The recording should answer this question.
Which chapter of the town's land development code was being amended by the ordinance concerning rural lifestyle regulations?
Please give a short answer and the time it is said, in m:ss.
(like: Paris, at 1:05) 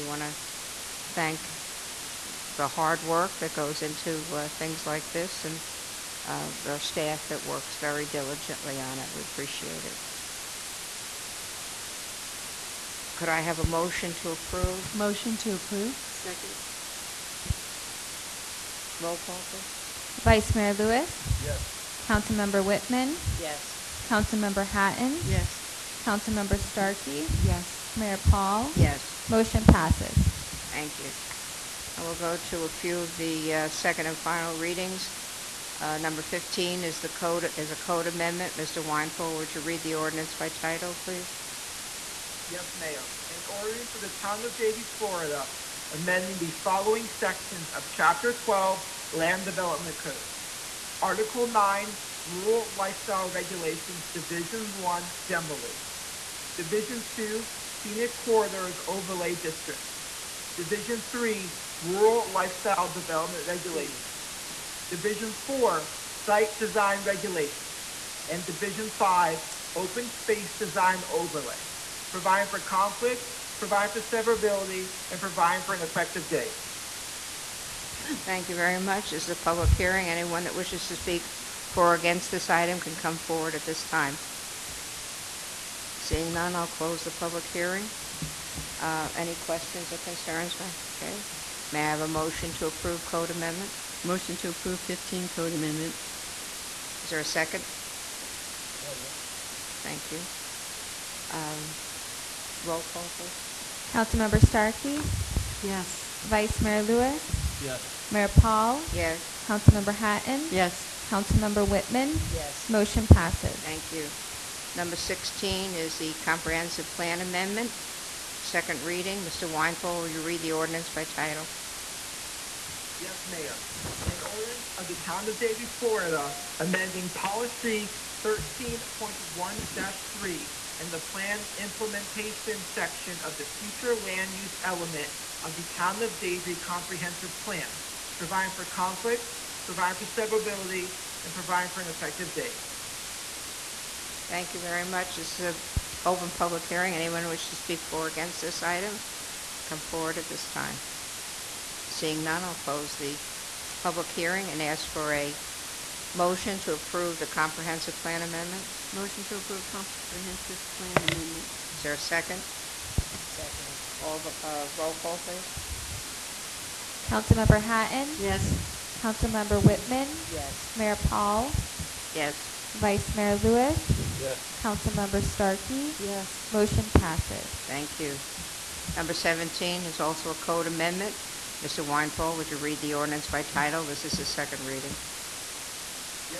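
Chapter 12, at 0:47.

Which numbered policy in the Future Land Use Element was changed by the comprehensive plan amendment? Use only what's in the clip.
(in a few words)
13.1-3.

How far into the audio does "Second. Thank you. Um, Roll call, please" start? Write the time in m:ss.
1:38.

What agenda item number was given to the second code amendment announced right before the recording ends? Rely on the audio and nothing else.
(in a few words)
17.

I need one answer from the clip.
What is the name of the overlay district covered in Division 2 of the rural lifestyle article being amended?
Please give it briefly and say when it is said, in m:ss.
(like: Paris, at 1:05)
Scenic Corridors Overlay District, at 0:57.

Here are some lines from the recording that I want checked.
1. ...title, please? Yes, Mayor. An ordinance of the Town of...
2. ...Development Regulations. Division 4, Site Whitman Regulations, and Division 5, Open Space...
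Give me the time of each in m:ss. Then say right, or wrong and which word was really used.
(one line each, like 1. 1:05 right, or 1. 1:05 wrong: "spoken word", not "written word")
1. 0:40 right
2. 1:02 wrong: "Design", not "Whitman".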